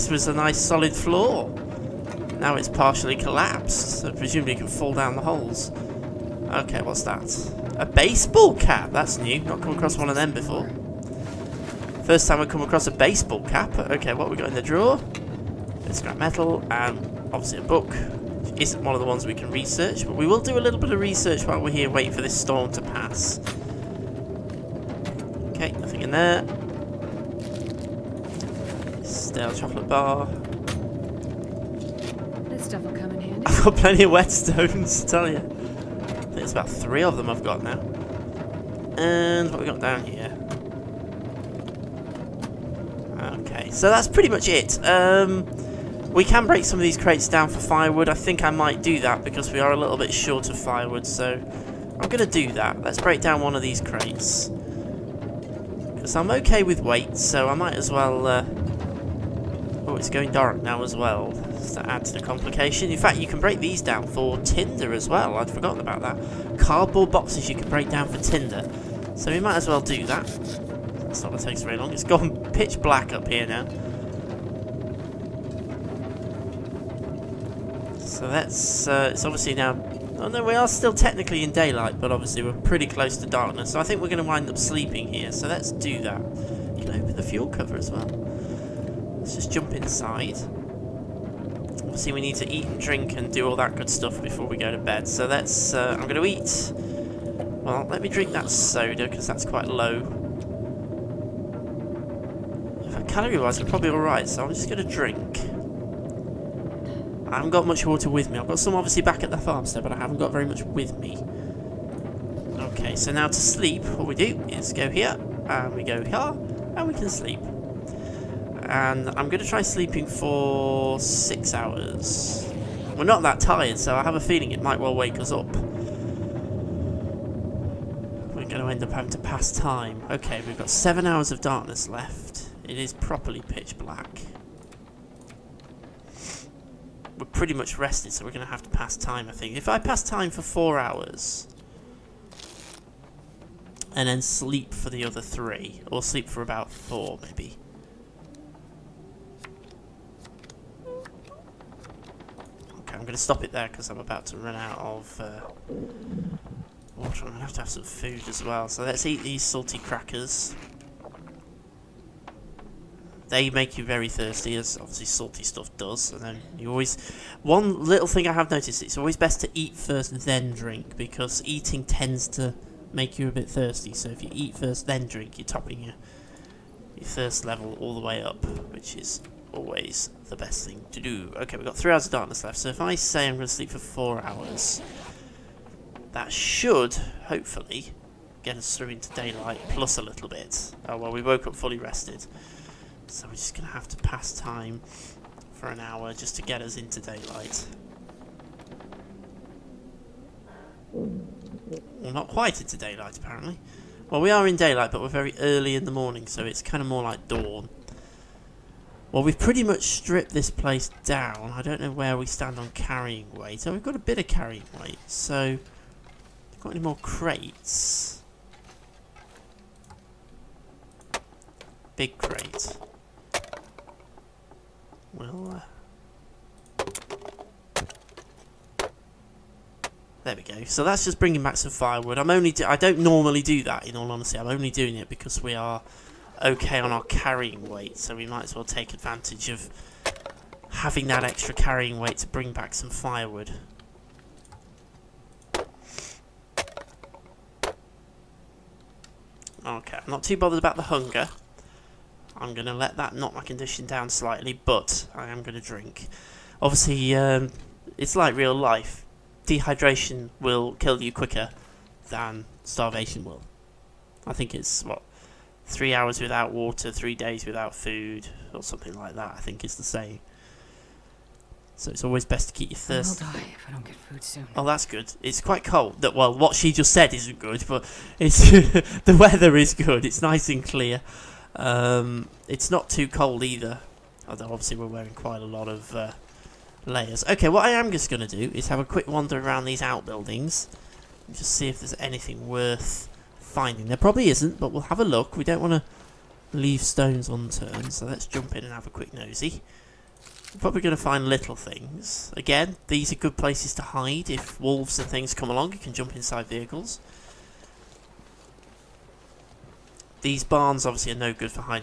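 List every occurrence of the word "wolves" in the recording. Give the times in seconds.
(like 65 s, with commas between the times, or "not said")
304 s.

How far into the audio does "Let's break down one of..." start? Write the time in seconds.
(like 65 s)
52 s.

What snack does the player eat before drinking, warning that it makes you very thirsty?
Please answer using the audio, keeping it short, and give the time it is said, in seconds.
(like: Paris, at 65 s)
salty crackers, at 159 s.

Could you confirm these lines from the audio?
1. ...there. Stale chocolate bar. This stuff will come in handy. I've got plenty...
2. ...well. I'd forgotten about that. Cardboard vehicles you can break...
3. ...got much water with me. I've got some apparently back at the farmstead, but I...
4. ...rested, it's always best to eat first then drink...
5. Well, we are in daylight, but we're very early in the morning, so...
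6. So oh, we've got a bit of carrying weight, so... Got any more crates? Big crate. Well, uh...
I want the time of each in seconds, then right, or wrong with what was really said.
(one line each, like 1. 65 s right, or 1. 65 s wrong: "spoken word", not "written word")
1. 26 s right
2. 65 s wrong: "boxes", not "vehicles"
3. 107 s wrong: "obviously", not "apparently"
4. 168 s wrong: "noticed", not "rested"
5. 204 s right
6. 213 s right.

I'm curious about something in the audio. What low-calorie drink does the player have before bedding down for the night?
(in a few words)
soda.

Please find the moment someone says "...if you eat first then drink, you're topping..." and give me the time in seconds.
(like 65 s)
174 s.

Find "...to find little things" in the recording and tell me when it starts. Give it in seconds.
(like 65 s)
300 s.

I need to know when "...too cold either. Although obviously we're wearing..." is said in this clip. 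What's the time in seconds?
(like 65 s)
282 s.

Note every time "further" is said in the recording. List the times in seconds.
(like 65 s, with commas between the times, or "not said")
not said.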